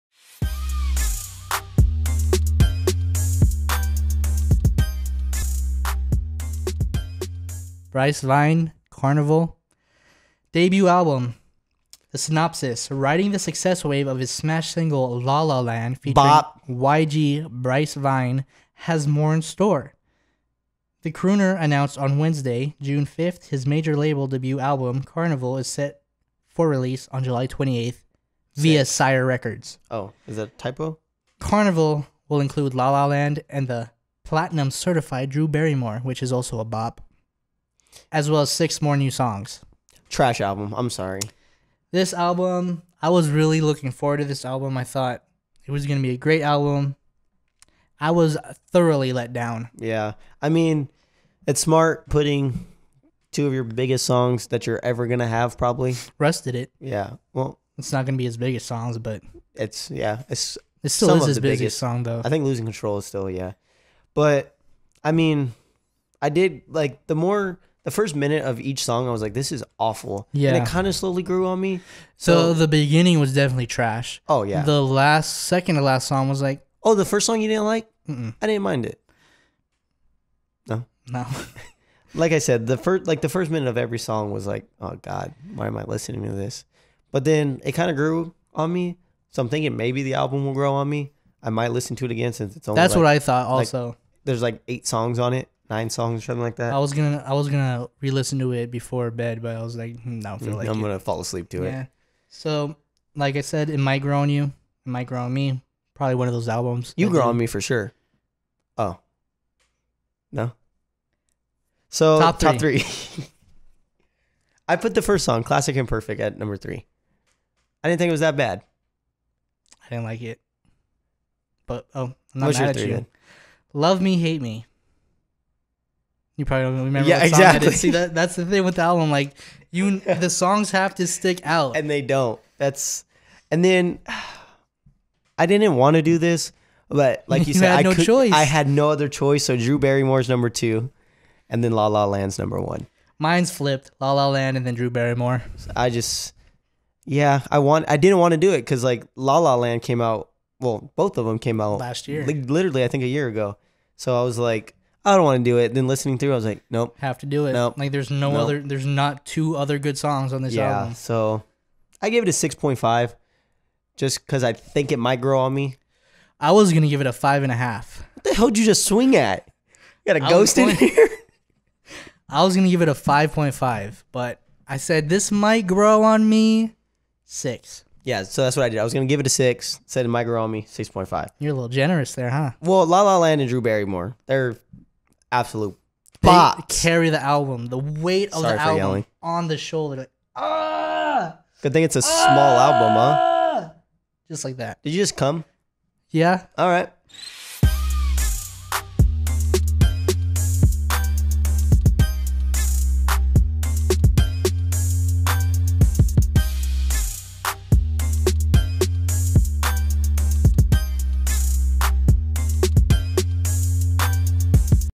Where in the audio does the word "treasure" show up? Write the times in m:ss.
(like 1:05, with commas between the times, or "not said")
not said.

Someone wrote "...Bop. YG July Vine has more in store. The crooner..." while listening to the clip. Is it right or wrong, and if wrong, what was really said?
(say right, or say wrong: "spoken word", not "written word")
wrong: "Bryce", not "July".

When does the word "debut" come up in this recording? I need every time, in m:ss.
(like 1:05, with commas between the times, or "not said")
0:10, 0:24.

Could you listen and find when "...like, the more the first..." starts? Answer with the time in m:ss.
1:06.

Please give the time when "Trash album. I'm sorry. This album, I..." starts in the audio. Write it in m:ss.
0:40.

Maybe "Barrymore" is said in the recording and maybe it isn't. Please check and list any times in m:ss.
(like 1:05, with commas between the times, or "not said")
0:35, 2:19, 2:24, 3:03.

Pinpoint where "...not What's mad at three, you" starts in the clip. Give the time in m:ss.
2:02.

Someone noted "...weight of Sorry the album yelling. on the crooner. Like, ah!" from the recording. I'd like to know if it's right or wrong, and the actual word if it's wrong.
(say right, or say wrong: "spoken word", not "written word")
wrong: "shoulder", not "crooner".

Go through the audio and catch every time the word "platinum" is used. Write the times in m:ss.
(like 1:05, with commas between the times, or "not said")
0:34.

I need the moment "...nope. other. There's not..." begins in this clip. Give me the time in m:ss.
2:38.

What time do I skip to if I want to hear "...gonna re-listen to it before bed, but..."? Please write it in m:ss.
1:37.